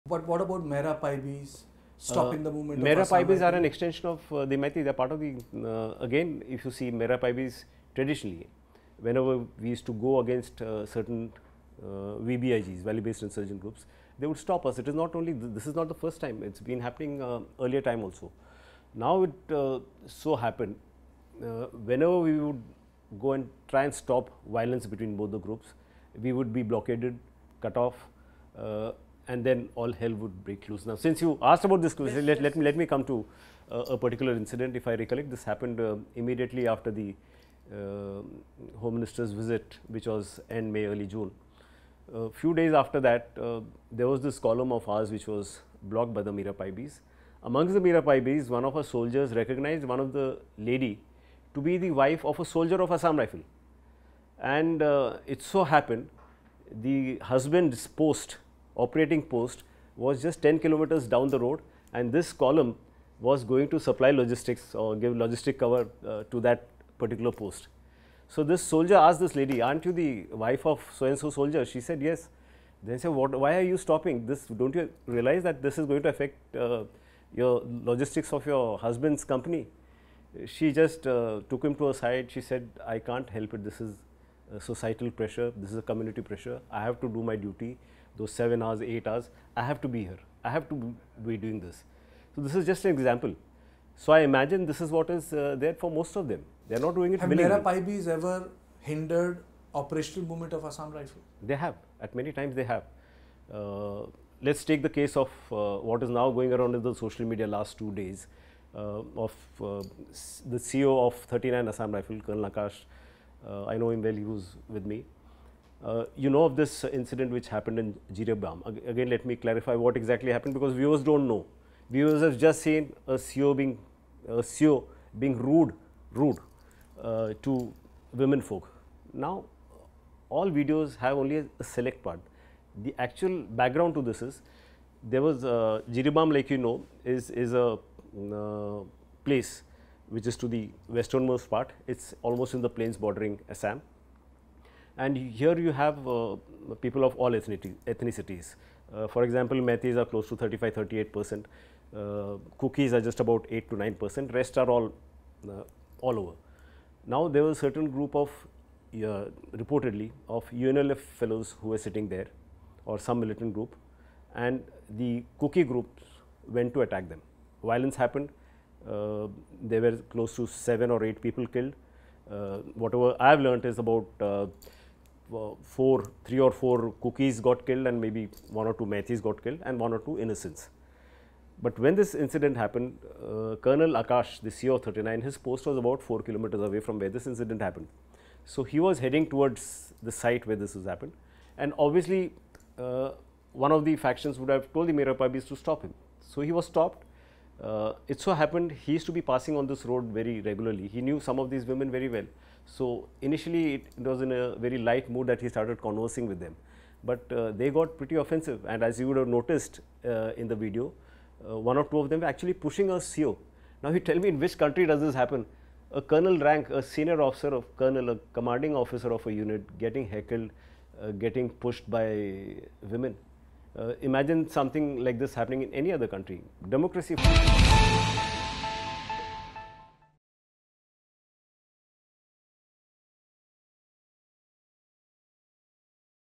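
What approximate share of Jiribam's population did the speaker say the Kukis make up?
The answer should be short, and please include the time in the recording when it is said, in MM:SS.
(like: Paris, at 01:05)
8 to 9 percent, at 02:33.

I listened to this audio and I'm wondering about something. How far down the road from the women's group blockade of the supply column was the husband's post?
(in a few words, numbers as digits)
10 kilometers.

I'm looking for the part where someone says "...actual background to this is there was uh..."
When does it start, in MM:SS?
02:12.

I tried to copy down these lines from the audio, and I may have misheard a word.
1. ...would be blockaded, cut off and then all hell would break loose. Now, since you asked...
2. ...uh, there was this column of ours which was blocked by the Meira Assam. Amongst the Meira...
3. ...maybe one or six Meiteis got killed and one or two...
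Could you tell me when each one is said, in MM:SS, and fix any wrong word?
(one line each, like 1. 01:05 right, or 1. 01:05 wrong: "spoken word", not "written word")
1. 00:26 right
2. 00:43 wrong: "Paibis", not "Assam"
3. 02:58 wrong: "two", not "six".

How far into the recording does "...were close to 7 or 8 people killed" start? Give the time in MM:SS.
02:49.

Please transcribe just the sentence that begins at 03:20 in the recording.
He knew some of these women very well.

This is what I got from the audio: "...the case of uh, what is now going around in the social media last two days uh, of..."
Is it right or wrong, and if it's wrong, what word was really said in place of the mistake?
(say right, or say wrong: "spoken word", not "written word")
right.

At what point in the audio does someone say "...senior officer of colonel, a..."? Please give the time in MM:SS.
03:36.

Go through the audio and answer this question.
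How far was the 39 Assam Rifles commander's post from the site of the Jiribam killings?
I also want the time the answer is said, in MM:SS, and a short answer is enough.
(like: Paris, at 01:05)
4 kilometers, at 03:06.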